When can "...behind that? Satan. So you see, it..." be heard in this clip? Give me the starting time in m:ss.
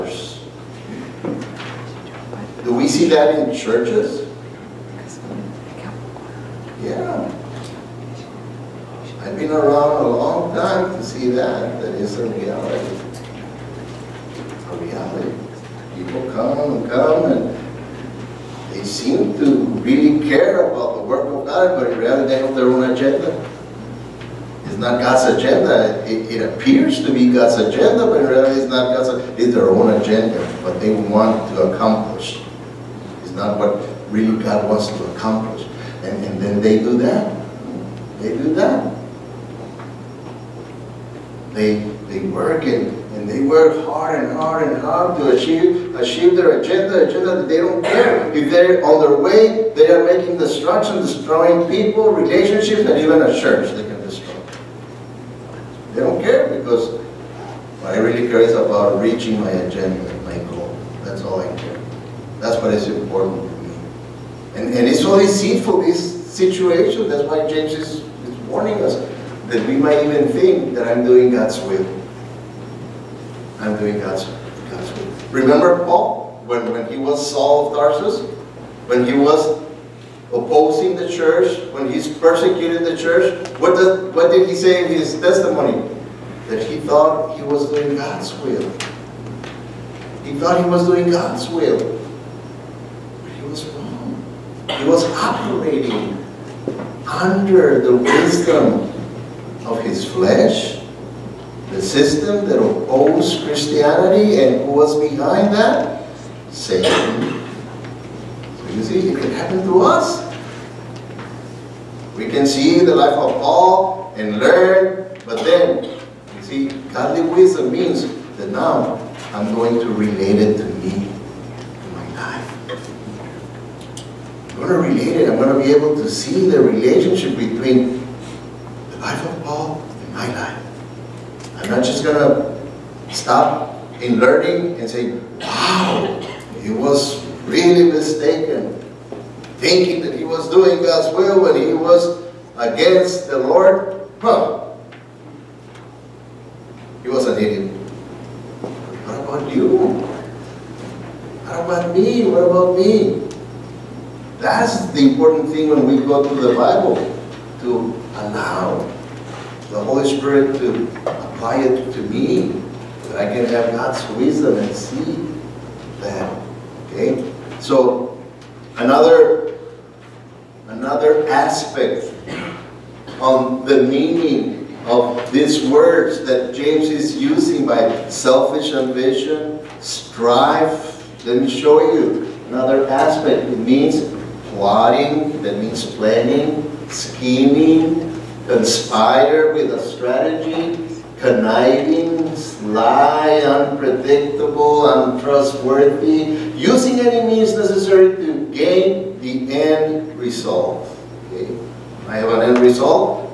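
1:44.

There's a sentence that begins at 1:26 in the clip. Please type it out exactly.
That he thought he was doing God's will.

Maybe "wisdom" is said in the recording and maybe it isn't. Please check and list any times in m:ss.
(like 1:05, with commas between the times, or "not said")
1:37, 1:57, 2:44.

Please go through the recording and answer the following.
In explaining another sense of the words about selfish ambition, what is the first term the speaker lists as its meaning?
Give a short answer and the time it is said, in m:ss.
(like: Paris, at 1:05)
Plotting, at 3:04.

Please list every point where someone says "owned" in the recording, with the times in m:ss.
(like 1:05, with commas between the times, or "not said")
not said.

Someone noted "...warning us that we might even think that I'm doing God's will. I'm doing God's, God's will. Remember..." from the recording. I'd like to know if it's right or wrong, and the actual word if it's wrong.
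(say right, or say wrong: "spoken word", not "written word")
right.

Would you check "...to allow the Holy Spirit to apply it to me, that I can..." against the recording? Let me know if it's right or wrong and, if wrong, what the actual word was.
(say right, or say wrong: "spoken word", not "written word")
right.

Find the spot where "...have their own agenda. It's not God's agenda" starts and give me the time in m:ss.
0:22.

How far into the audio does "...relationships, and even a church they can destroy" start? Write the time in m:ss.
0:52.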